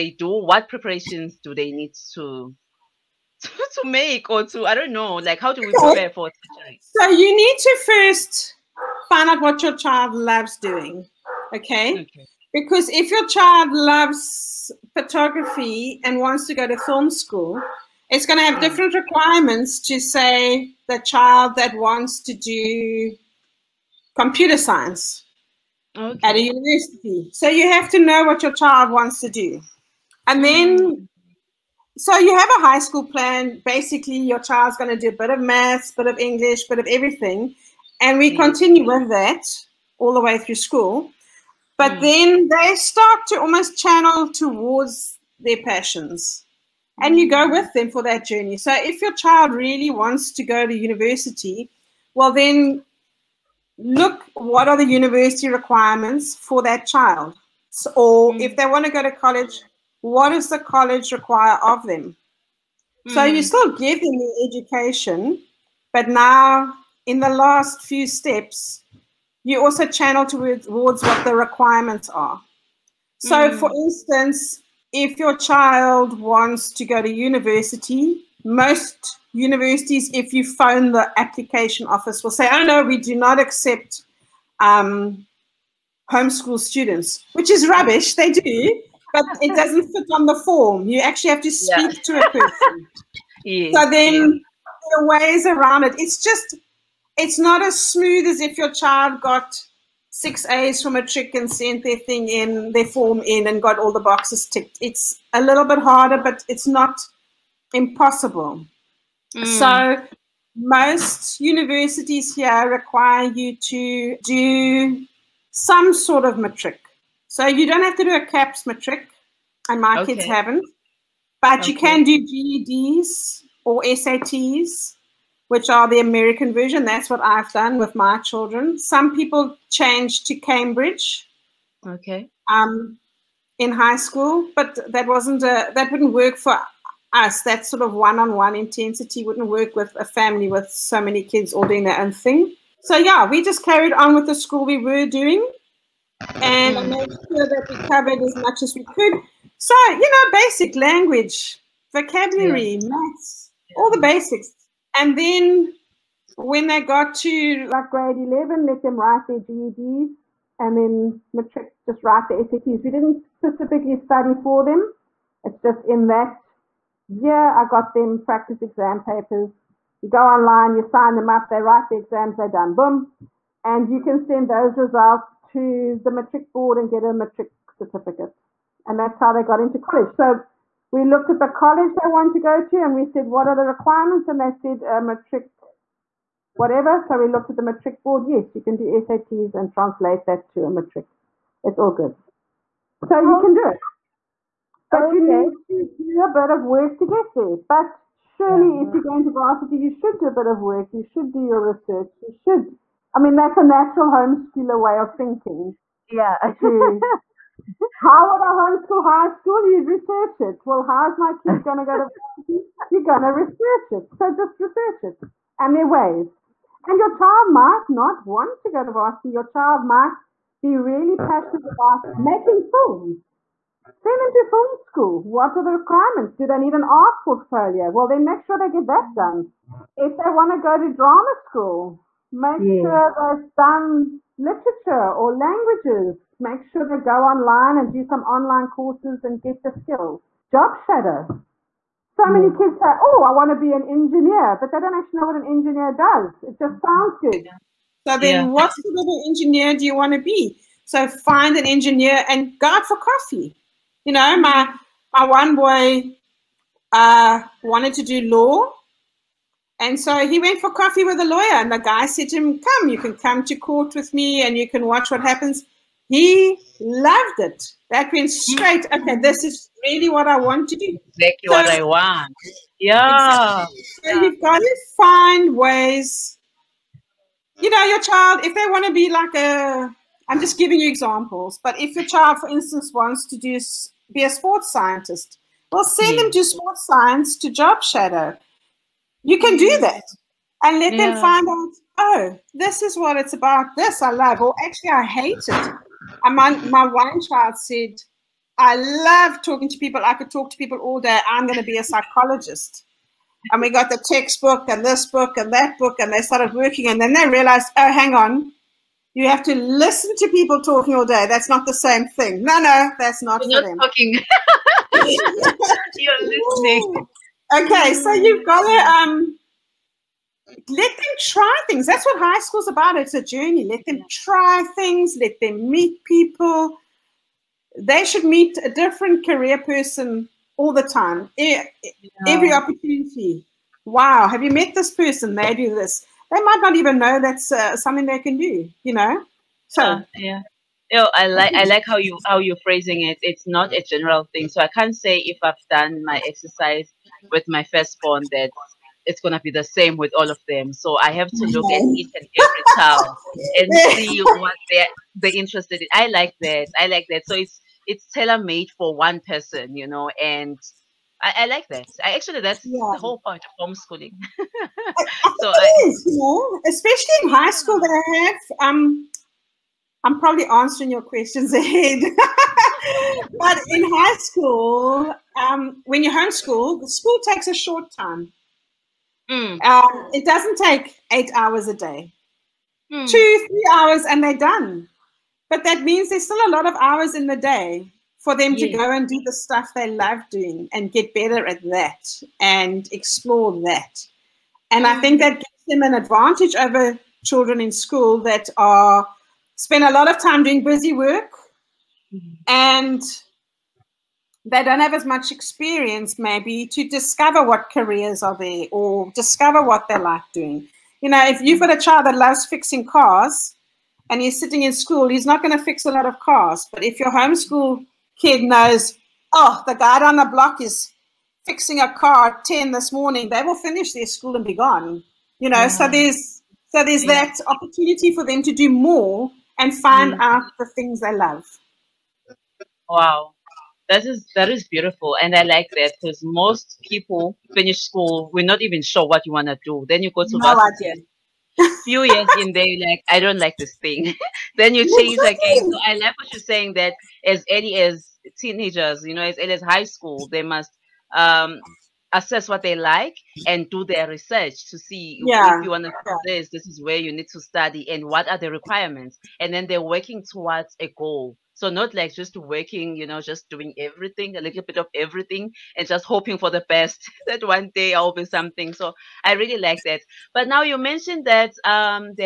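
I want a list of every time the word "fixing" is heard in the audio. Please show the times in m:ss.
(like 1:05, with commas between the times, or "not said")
6:52, 7:01.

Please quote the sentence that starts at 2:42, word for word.
We didn't specifically study for them.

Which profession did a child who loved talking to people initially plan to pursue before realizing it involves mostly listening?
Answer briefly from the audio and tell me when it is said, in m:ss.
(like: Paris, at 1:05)
psychologist, at 5:01.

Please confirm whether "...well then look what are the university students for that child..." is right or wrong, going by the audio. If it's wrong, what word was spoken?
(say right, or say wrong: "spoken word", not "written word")
wrong: "requirements", not "students".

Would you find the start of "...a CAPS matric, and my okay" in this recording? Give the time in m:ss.
1:58.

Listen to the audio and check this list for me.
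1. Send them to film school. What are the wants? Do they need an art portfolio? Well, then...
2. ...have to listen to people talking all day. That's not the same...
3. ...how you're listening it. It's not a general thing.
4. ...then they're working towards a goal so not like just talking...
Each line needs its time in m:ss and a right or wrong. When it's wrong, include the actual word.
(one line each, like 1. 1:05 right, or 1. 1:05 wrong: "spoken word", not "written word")
1. 3:43 wrong: "requirements", not "wants"
2. 5:09 right
3. 5:42 wrong: "phrasing", not "listening"
4. 7:39 wrong: "working", not "talking".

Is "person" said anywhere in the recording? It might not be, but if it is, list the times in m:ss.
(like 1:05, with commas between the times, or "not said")
1:32, 5:29, 5:34, 5:59.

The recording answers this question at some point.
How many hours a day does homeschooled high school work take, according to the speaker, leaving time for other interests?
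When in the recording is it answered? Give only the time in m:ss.
6:23.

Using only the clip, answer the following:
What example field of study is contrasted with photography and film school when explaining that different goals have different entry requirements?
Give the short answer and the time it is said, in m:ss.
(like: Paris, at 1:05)
computer science, at 0:24.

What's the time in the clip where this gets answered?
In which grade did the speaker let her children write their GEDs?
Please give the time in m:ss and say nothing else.
2:37.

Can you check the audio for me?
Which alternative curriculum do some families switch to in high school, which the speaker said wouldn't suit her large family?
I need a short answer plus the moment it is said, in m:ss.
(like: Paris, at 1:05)
Cambridge, at 2:10.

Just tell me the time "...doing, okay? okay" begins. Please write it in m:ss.
0:10.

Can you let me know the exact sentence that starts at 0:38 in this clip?
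continue with that all the way through school.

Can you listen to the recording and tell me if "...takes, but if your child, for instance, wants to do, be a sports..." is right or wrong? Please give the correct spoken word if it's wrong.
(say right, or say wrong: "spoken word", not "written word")
wrong: "examples", not "takes".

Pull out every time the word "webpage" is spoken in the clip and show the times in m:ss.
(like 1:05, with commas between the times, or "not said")
not said.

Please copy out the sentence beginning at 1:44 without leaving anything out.
It's a little bit harder, but it's not impossible.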